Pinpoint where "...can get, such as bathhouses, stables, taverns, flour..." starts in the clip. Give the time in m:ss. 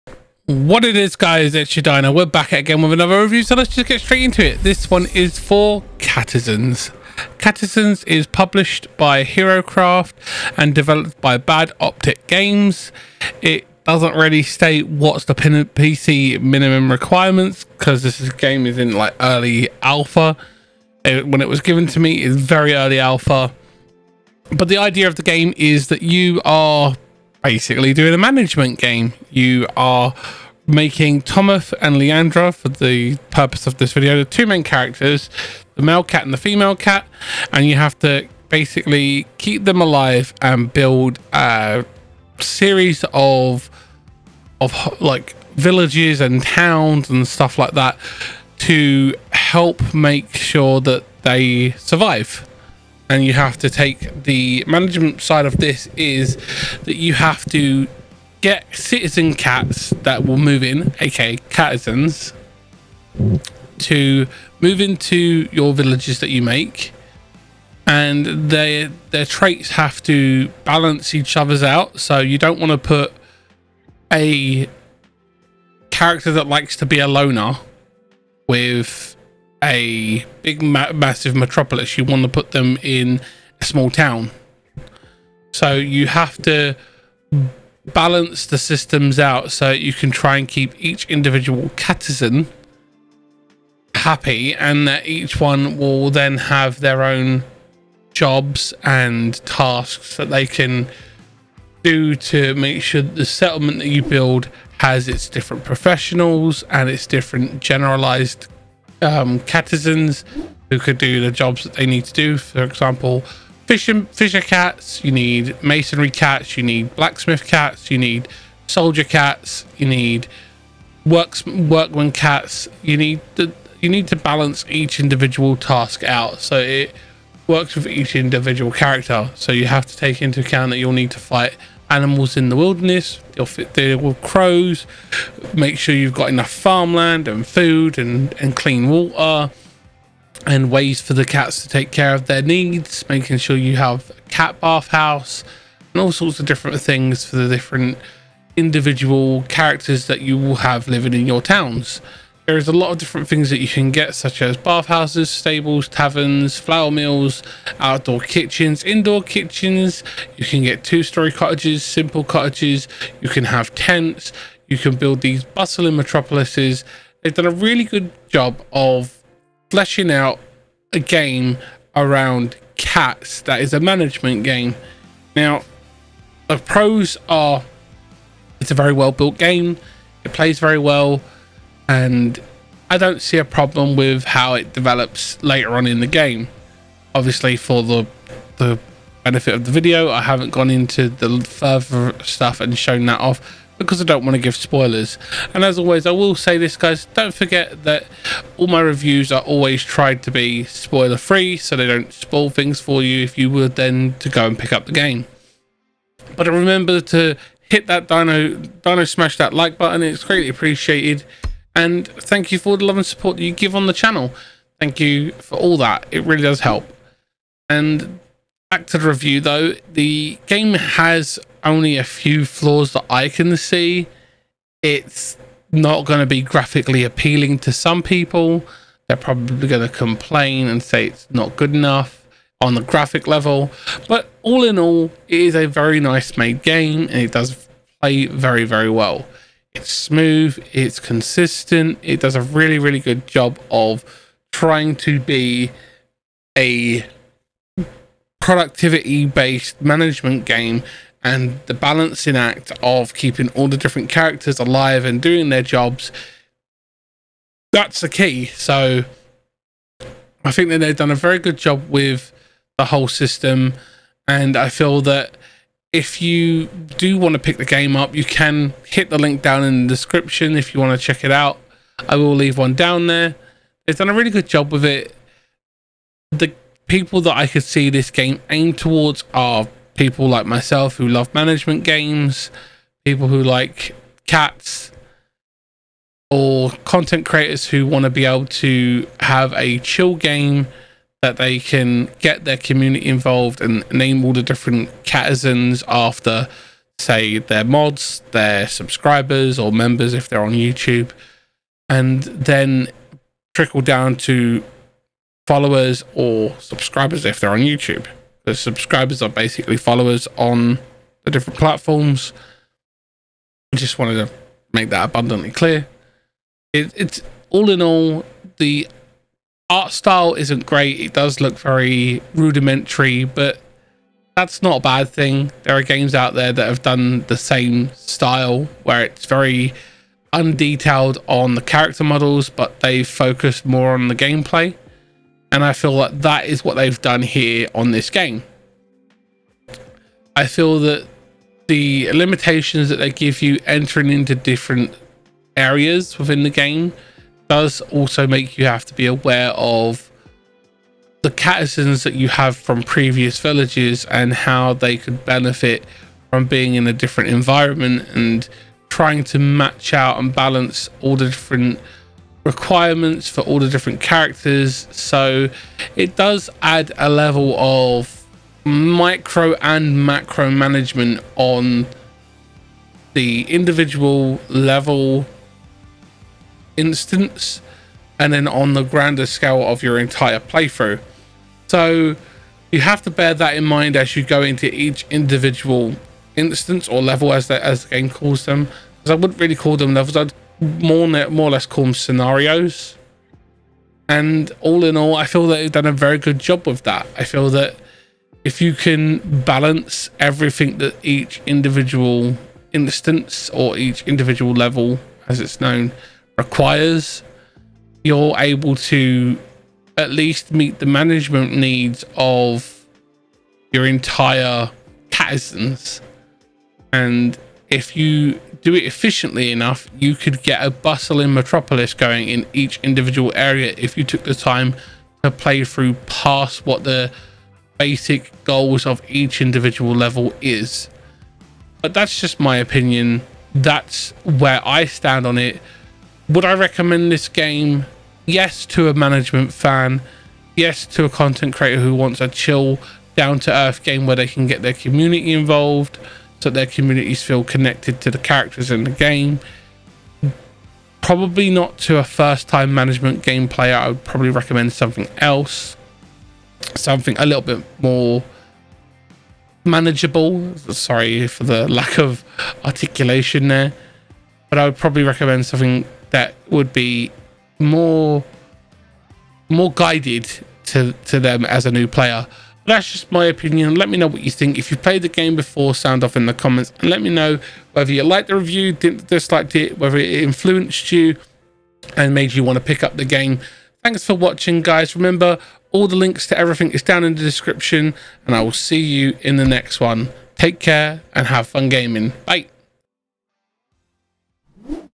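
2:33.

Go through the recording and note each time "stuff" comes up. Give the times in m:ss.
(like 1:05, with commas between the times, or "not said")
0:47, 3:12.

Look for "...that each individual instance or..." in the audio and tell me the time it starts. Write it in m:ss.
6:40.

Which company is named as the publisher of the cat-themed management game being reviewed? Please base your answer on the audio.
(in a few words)
HeroCraft.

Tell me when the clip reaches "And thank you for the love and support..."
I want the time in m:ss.
3:31.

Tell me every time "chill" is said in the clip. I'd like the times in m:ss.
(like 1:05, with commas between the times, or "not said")
4:49, 7:22.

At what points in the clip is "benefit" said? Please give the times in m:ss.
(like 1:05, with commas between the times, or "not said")
3:09, 5:55.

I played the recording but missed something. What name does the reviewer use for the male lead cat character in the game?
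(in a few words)
Thomas.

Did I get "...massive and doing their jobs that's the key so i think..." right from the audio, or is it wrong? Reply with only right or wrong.
wrong.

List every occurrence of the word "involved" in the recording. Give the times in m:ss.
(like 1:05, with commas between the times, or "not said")
4:53, 7:25.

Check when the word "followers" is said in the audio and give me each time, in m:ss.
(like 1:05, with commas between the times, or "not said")
5:05, 5:09.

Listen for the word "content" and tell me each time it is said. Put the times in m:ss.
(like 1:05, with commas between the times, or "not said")
4:46, 7:21.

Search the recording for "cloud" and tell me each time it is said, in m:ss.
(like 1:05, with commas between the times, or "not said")
not said.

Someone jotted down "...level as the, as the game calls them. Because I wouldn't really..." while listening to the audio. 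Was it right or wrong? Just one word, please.
right.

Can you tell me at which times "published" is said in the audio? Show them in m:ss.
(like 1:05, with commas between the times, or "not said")
0:08.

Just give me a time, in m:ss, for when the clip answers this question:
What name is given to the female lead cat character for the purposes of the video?
0:31.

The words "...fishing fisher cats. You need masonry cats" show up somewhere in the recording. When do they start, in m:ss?
1:53.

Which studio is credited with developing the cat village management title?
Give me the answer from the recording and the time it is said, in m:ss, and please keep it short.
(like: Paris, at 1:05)
Bad Optic Games, at 0:11.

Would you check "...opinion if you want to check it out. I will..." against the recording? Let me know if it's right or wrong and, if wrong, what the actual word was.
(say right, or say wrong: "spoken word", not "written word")
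wrong: "description", not "opinion".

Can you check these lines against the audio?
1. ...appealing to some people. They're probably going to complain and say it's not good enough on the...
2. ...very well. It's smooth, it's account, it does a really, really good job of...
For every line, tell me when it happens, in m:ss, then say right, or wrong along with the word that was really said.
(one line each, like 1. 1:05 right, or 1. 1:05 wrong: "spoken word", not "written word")
1. 3:47 right
2. 3:58 wrong: "consistent", not "account".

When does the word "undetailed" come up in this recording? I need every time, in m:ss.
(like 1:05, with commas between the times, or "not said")
5:30.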